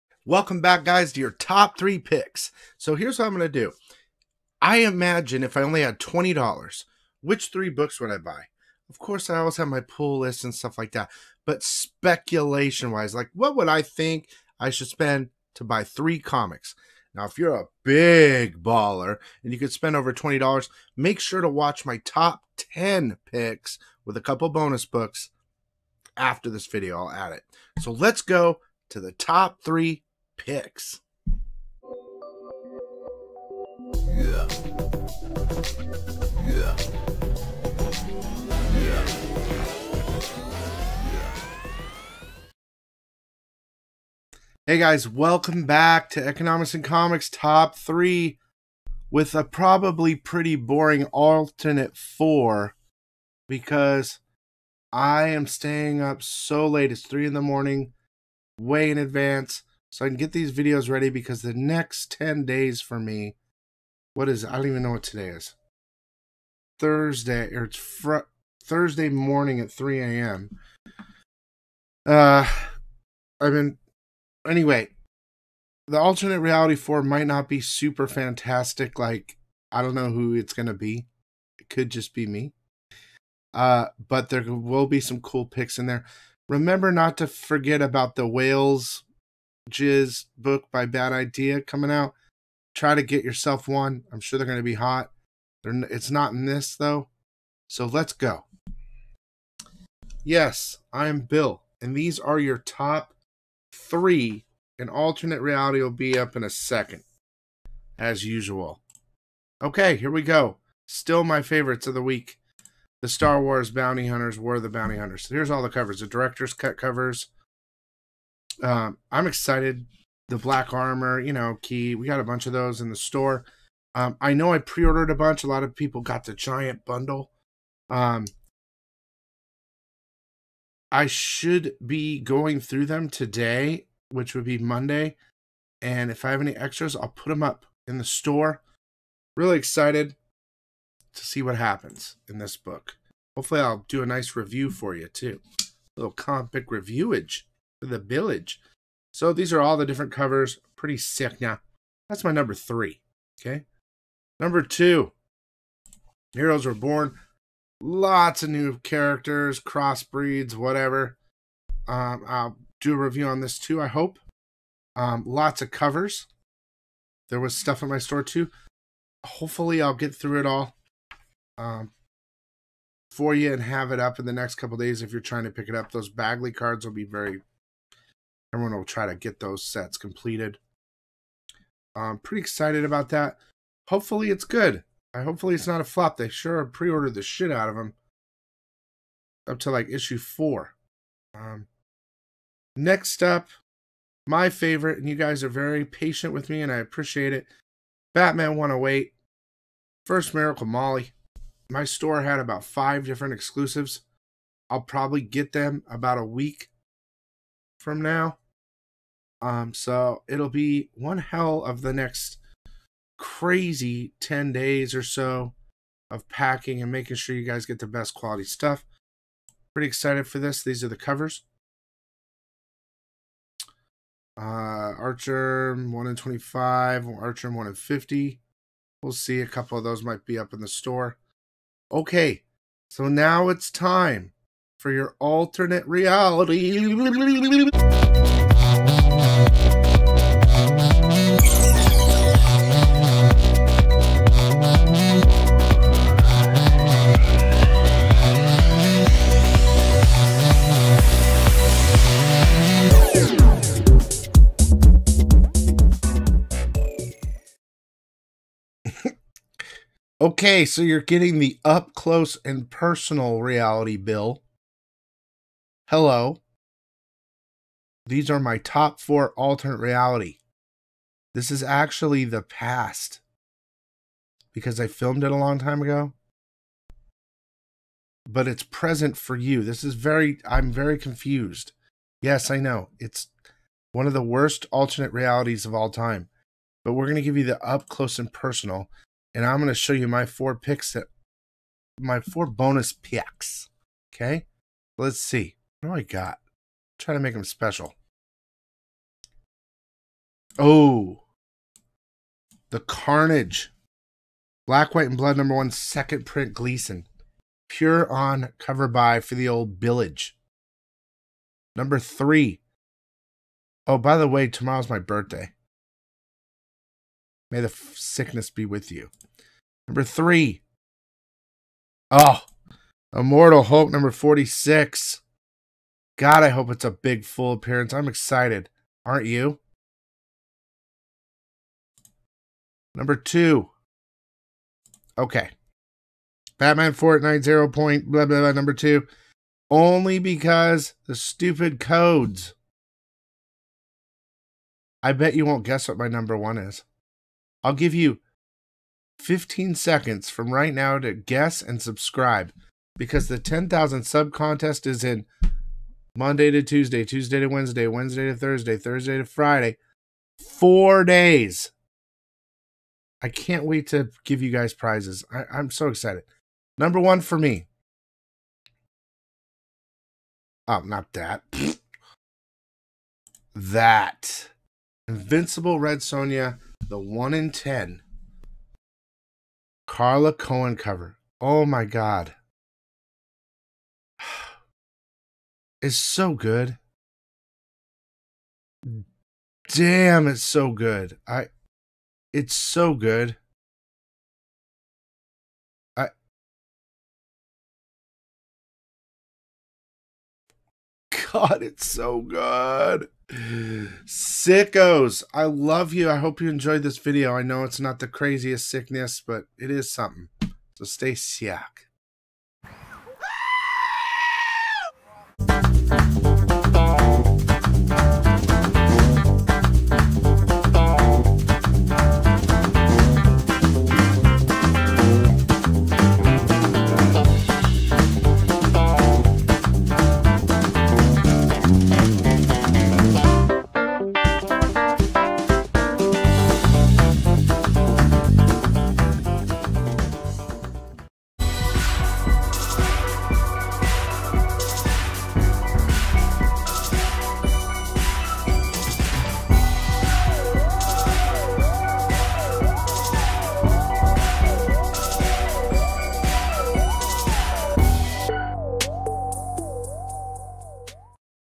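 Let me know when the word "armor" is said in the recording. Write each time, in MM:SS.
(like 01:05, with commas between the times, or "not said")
02:00.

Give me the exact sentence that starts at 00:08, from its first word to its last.
Of course, I always have my pull list and stuff like that.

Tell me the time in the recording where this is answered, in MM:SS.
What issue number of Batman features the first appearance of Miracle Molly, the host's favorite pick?
03:18.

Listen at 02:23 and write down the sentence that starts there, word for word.
Hopefully, I'll do a nice review for you too.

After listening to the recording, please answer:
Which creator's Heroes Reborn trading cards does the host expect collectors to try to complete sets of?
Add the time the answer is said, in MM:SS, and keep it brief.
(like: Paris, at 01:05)
Bagley, at 02:56.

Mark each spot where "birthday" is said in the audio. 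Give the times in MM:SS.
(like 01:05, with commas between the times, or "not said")
05:14.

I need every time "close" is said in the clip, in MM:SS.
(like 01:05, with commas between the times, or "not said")
04:21, 04:47.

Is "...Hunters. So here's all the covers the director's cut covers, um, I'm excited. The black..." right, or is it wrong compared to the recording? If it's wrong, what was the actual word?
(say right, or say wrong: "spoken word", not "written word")
right.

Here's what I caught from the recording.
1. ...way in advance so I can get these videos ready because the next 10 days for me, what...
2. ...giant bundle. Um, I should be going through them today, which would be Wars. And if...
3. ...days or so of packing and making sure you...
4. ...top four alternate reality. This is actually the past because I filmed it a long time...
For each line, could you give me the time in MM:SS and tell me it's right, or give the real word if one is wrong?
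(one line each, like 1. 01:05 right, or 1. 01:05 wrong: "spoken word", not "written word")
1. 00:58 right
2. 02:06 wrong: "Monday", not "Wars"
3. 03:34 right
4. 04:28 right.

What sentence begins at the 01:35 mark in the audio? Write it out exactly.
They're, it's not in this, though.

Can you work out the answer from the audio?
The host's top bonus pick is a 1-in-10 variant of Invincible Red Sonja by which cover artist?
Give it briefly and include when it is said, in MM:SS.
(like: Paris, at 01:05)
Carla Cohen, at 06:19.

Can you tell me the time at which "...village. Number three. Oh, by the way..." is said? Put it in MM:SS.
05:09.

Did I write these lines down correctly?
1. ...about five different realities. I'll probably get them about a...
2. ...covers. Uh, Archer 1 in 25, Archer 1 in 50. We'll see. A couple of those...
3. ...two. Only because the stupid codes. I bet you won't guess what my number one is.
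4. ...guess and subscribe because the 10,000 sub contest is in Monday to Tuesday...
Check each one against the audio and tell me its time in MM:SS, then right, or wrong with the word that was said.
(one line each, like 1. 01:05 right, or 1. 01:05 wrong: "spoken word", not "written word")
1. 03:22 wrong: "exclusives", not "realities"
2. 03:40 right
3. 05:38 right
4. 05:51 right.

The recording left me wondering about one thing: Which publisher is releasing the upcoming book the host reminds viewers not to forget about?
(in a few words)
Bad Idea.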